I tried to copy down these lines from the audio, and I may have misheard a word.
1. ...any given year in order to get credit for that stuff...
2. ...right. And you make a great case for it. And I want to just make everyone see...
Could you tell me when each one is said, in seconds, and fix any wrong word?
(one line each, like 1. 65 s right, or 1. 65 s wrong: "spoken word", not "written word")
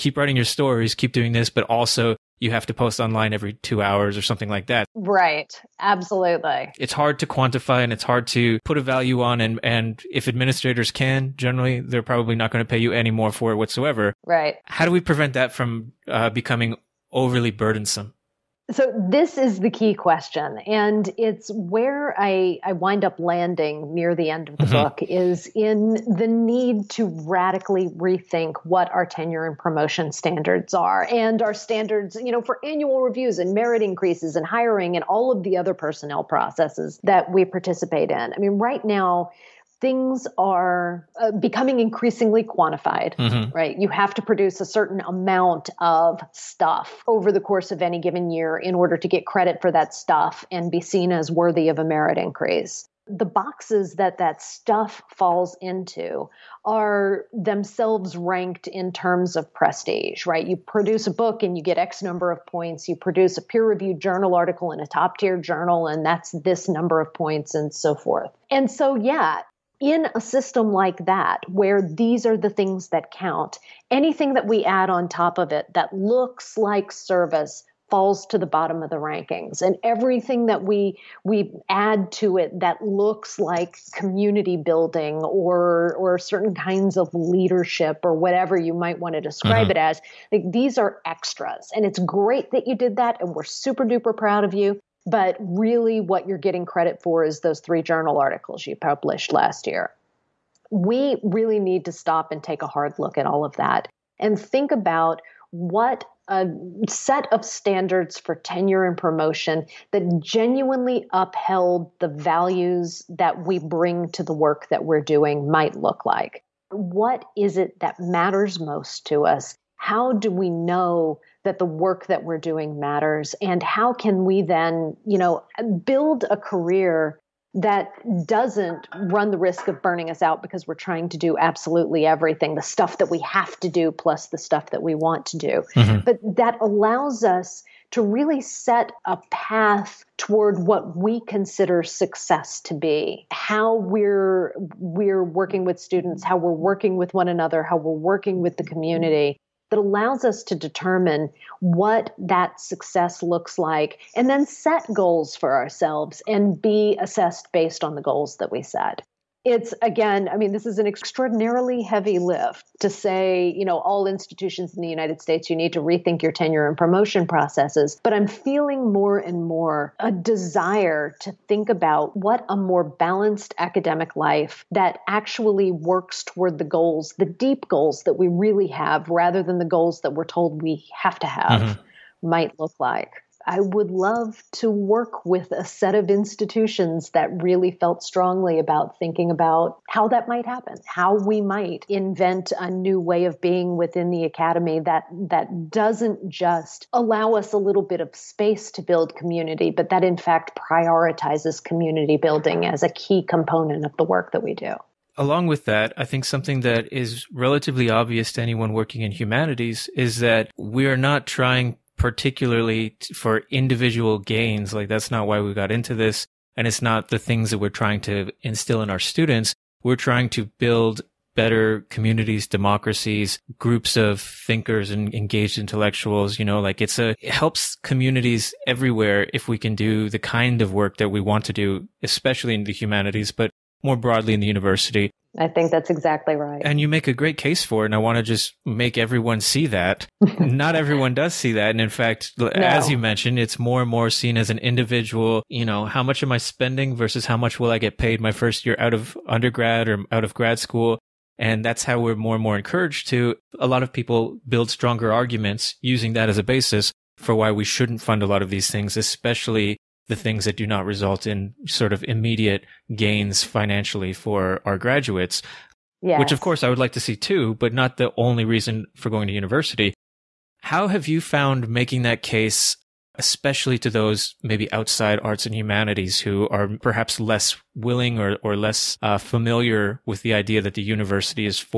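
1. 47 s right
2. 236 s right.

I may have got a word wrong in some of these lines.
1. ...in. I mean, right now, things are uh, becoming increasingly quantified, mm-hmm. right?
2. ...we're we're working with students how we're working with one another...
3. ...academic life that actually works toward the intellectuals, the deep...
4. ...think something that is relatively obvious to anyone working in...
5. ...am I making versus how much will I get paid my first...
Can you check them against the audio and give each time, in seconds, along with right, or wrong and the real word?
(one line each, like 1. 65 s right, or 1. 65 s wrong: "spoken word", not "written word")
1. 38 s right
2. 143 s right
3. 173 s wrong: "goals", not "intellectuals"
4. 206 s right
5. 246 s wrong: "spending", not "making".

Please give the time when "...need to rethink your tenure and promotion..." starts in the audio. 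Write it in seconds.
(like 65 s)
165 s.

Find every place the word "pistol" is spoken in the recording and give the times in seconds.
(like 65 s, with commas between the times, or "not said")
not said.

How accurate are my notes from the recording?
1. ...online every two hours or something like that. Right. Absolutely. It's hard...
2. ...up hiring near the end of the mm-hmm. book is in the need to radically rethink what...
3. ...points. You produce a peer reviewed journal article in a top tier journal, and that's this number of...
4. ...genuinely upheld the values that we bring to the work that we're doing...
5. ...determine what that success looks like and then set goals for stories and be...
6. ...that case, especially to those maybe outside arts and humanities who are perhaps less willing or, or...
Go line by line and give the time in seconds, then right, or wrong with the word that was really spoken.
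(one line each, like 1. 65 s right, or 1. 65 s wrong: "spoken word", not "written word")
1. 2 s right
2. 23 s wrong: "landing", not "hiring"
3. 62 s right
4. 110 s right
5. 150 s wrong: "ourselves", not "stories"
6. 272 s right.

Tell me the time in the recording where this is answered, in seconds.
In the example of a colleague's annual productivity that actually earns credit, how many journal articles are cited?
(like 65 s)
97 s.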